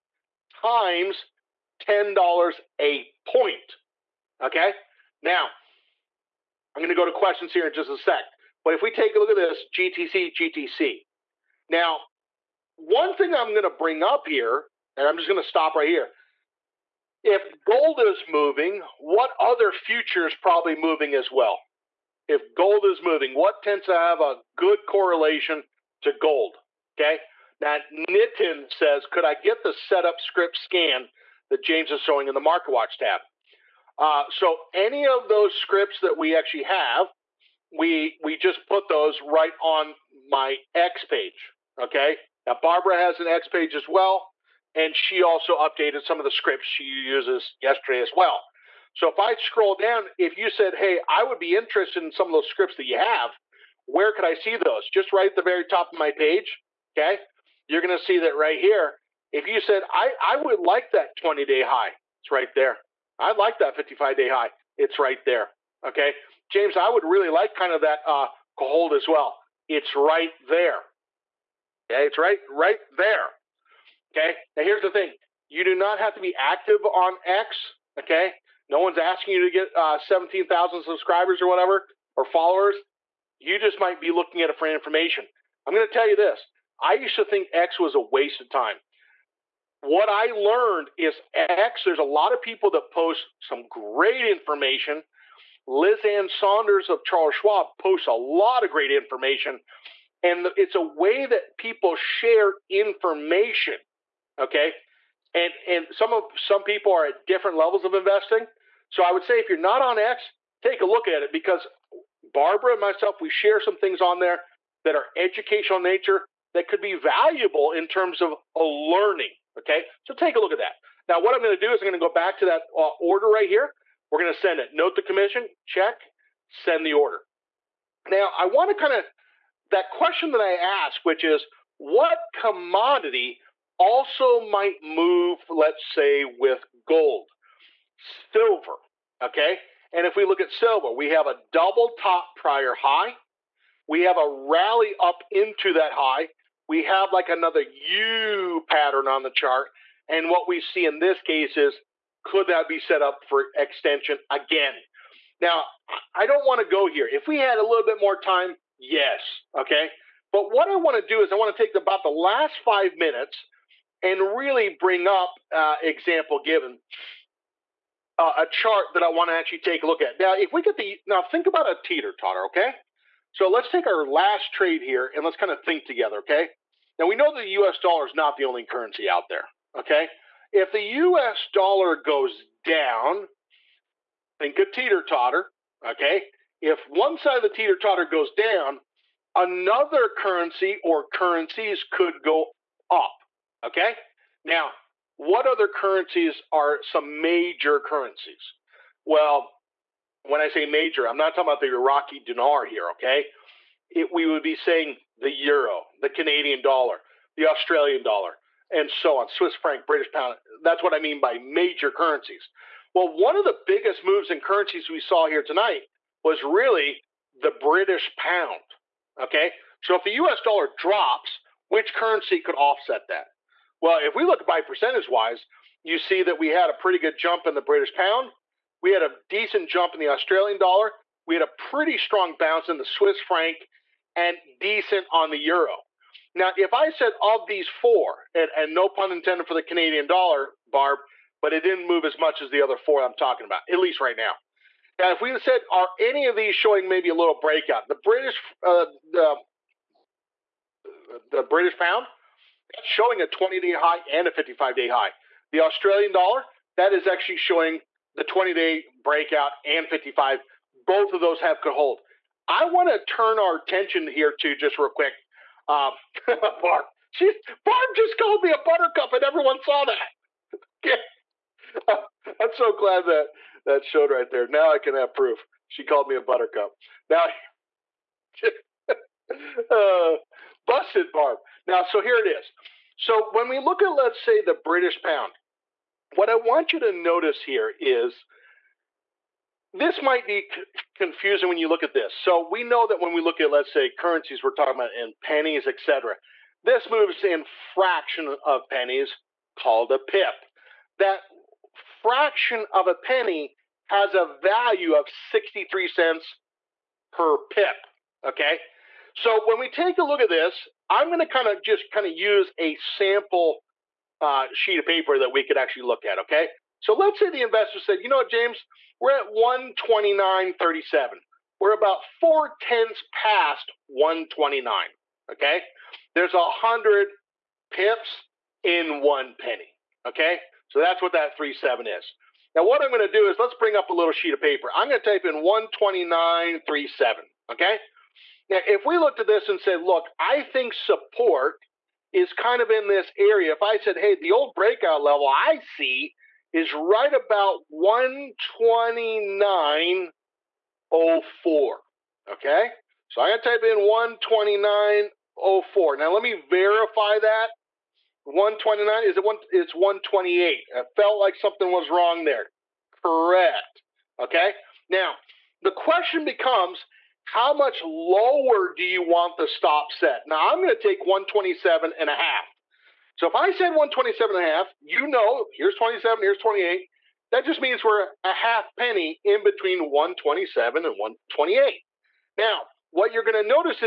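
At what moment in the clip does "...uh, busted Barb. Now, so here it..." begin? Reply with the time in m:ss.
4:39.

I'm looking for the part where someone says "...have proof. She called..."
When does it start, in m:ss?
4:34.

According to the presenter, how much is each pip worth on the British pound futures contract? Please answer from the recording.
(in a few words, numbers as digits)
63 cents.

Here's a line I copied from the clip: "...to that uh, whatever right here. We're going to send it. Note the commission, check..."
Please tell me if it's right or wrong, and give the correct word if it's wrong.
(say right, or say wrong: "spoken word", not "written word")
wrong: "order", not "whatever".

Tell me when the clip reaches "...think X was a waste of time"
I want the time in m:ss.
1:27.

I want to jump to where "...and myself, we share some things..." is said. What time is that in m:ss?
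1:52.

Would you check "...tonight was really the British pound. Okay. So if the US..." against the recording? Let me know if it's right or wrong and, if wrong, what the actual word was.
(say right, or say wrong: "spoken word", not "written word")
right.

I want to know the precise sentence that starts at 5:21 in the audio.
We're about four tenths past 129.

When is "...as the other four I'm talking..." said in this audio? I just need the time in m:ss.
4:02.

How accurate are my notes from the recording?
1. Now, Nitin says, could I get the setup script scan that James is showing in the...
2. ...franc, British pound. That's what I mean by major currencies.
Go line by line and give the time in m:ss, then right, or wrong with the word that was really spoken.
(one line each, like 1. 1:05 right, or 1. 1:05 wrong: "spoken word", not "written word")
1. 0:27 right
2. 3:29 right.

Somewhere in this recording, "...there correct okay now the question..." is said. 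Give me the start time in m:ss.
6:02.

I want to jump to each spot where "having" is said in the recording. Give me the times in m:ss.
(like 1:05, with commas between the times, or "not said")
not said.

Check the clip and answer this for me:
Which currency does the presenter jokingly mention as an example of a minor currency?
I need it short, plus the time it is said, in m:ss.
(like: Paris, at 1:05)
Iraqi dinar, at 3:21.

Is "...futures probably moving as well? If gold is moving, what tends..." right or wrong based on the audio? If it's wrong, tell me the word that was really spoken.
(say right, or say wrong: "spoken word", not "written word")
right.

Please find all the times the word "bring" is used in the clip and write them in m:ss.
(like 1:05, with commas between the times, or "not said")
0:13, 2:44, 5:33.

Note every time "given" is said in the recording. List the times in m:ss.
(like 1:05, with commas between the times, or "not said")
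2:46.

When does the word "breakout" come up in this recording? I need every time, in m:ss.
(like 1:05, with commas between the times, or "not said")
4:07, 4:18, 5:44.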